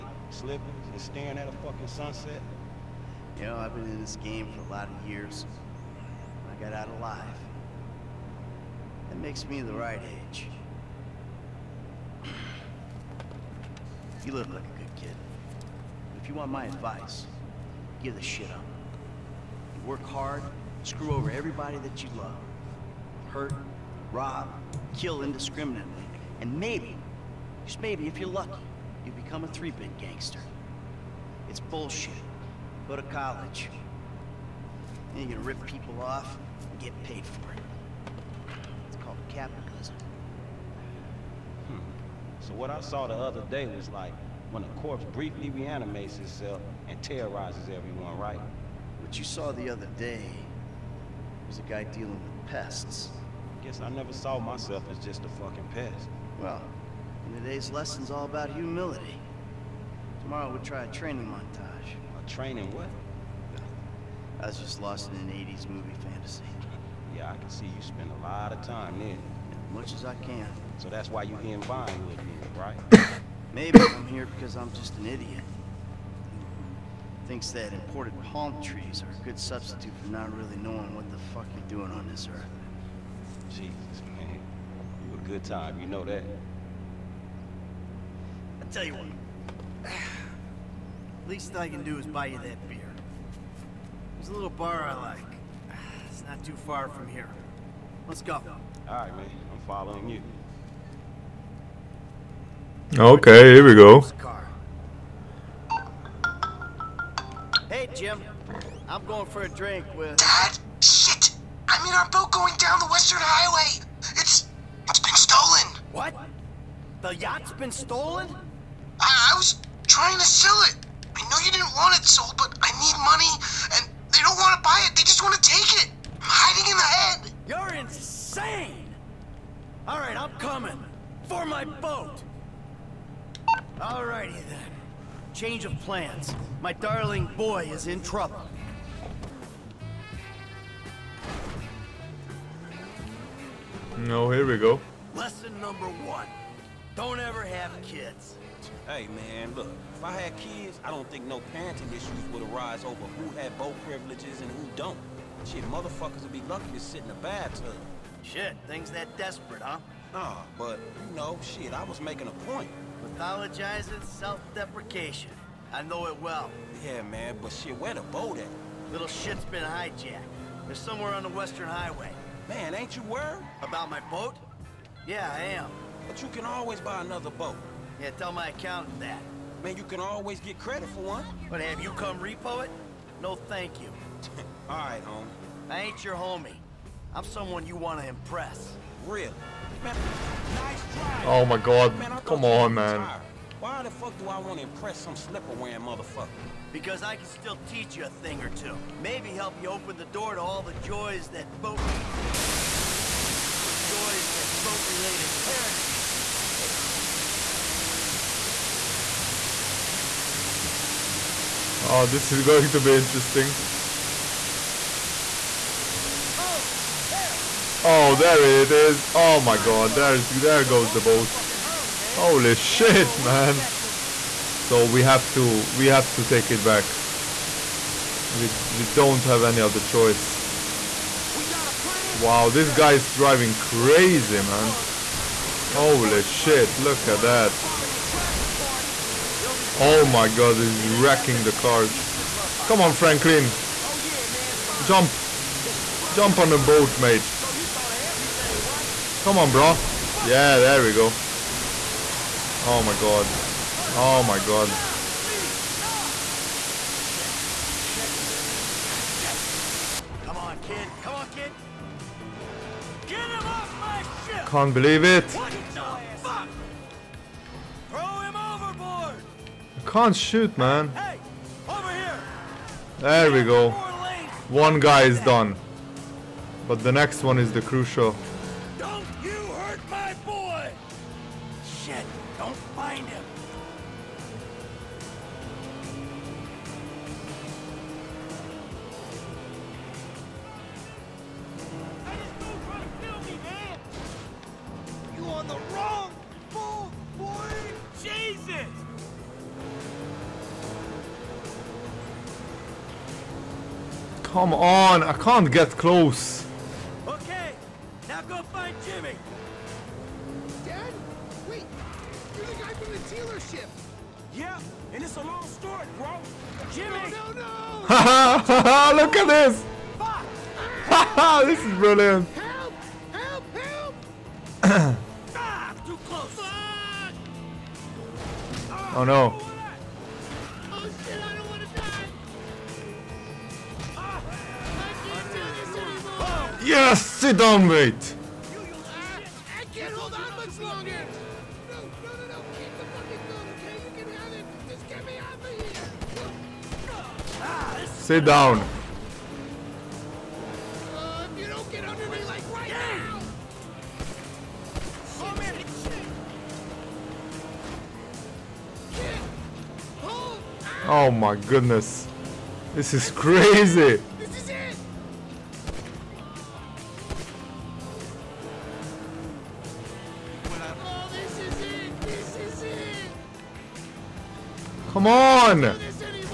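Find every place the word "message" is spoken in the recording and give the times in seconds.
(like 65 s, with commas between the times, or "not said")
not said.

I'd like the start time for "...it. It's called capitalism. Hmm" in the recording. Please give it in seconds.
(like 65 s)
37 s.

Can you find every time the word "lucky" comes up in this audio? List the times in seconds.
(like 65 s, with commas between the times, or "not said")
28 s, 156 s.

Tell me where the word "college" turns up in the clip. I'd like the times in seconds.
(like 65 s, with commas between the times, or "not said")
33 s.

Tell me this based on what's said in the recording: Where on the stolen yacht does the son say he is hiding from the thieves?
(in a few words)
The head.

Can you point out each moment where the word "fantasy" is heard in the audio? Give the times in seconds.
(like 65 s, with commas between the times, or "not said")
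66 s.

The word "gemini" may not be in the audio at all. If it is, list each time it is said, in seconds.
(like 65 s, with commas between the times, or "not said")
not said.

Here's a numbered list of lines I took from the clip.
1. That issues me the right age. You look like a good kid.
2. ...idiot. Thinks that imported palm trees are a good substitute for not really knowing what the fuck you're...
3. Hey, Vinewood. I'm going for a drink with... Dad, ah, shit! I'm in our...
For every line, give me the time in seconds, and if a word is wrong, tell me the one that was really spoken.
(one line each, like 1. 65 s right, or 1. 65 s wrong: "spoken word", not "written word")
1. 9 s wrong: "makes", not "issues"
2. 75 s right
3. 107 s wrong: "Jim", not "Vinewood".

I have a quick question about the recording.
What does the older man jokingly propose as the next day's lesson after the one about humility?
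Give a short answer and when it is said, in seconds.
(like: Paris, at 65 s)
A training montage, at 60 s.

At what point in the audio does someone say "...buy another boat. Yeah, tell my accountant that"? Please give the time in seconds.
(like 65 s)
176 s.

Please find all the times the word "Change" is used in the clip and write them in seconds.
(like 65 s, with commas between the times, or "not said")
135 s.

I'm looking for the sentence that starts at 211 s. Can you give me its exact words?
Oh, this is going to be interesting.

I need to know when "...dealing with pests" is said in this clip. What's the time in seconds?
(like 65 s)
51 s.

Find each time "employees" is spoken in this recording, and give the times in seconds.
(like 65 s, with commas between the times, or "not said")
not said.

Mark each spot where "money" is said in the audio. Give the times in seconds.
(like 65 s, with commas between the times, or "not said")
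123 s.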